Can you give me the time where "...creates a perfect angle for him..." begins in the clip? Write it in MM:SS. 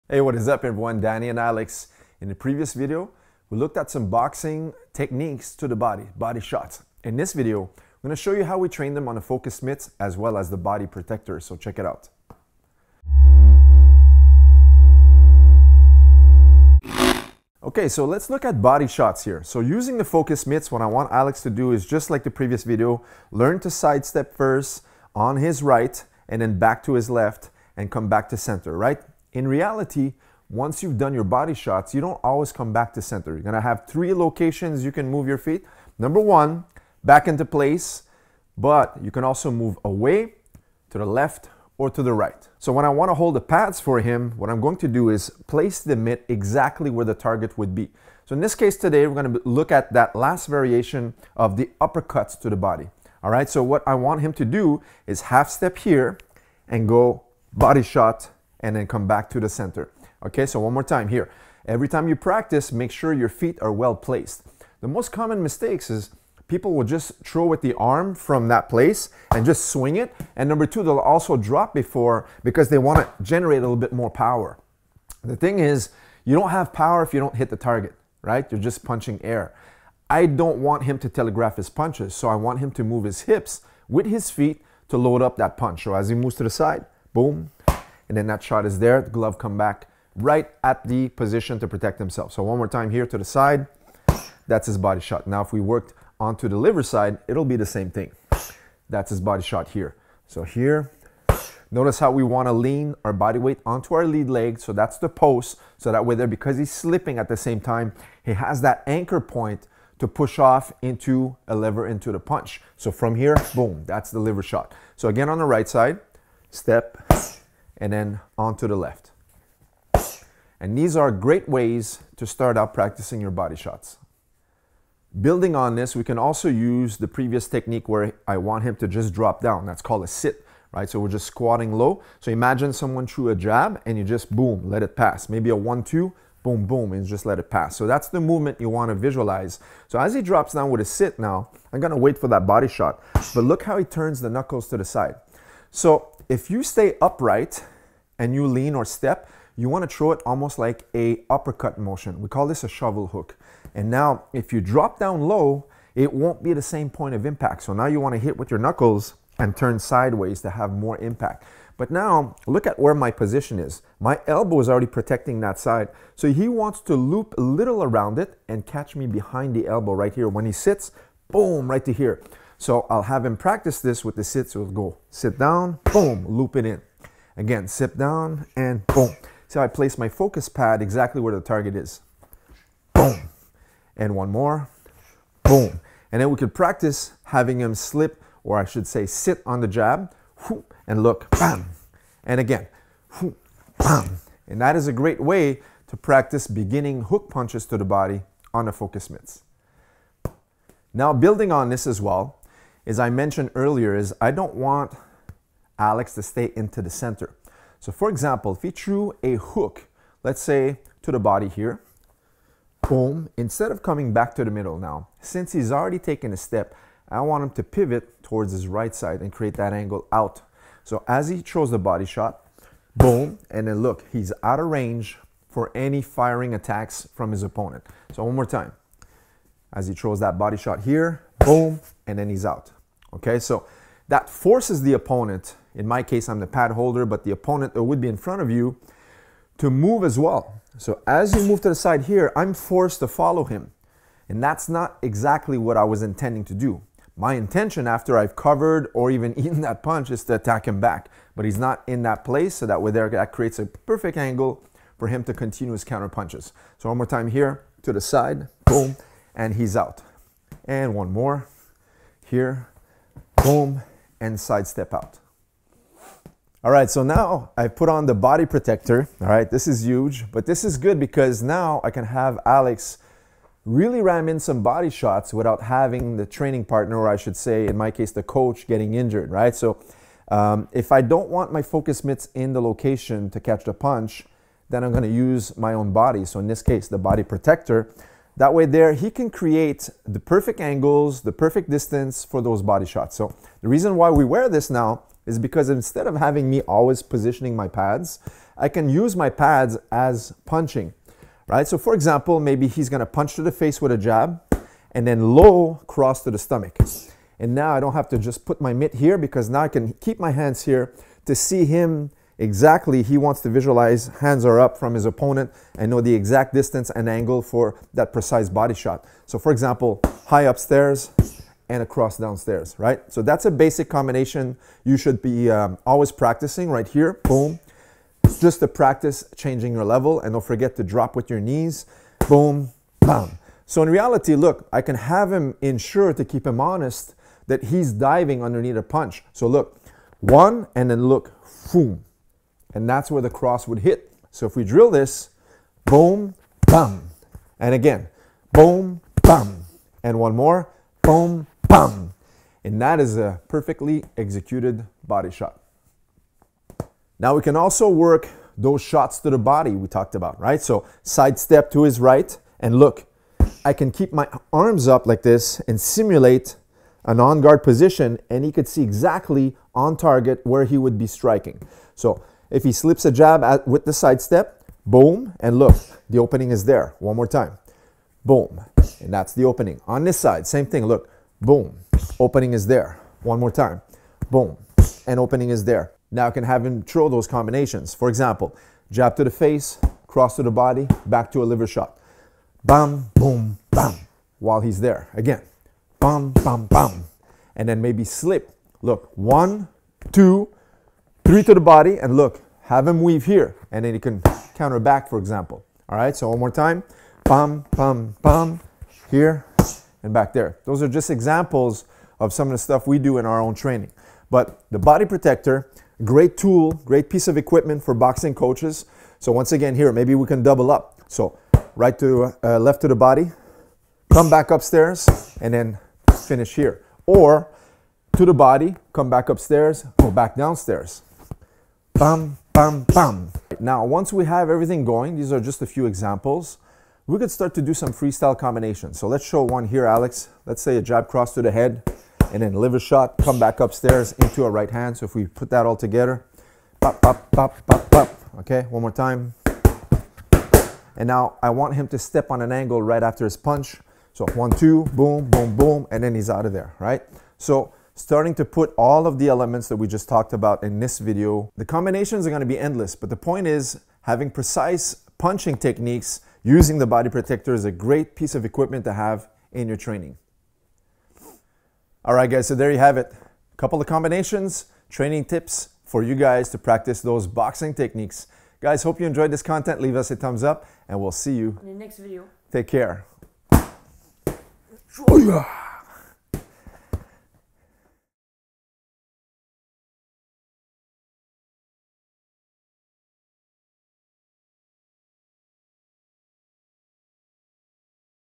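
04:13.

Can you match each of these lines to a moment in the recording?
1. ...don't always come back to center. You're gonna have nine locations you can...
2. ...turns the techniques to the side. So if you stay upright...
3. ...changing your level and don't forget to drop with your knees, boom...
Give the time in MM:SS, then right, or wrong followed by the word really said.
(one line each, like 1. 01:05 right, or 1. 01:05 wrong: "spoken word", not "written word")
1. 00:32 wrong: "three", not "nine"
2. 02:23 wrong: "knuckles", not "techniques"
3. 05:29 right.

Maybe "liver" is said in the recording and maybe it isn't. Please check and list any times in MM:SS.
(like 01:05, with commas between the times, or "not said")
01:36, 01:54, 06:31, 07:22.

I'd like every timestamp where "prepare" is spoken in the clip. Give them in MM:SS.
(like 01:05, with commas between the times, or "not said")
not said.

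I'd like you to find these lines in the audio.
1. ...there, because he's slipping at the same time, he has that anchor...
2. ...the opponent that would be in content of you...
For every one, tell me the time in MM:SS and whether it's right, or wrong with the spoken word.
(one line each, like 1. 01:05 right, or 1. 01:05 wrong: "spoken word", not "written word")
1. 01:46 right
2. 03:57 wrong: "front", not "content".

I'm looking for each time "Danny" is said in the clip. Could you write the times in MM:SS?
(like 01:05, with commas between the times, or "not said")
00:00.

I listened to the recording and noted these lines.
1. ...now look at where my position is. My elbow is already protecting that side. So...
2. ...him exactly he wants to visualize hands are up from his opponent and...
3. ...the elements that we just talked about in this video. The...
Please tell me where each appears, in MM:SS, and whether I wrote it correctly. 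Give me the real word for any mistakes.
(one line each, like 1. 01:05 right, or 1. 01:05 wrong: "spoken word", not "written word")
1. 02:41 right
2. 05:11 right
3. 07:39 right.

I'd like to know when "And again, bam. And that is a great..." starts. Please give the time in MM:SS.
03:12.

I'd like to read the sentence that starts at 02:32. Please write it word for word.
We call this a shovel hook.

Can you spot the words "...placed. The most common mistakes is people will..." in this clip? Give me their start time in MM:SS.
01:03.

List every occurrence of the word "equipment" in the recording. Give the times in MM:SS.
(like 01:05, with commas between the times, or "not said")
06:57, 07:48.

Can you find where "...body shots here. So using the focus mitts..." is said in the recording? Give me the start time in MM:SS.
00:18.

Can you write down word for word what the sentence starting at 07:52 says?
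All right, guys, so there you have it.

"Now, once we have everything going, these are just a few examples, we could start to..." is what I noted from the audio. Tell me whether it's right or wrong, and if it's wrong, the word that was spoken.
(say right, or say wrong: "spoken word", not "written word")
right.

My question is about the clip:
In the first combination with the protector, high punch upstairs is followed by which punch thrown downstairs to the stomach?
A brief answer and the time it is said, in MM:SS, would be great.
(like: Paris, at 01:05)
low cross, at 05:05.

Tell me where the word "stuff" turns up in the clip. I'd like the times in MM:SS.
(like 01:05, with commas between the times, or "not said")
06:52.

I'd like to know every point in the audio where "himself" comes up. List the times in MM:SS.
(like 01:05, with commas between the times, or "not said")
01:31.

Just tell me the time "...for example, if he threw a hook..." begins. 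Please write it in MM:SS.
03:27.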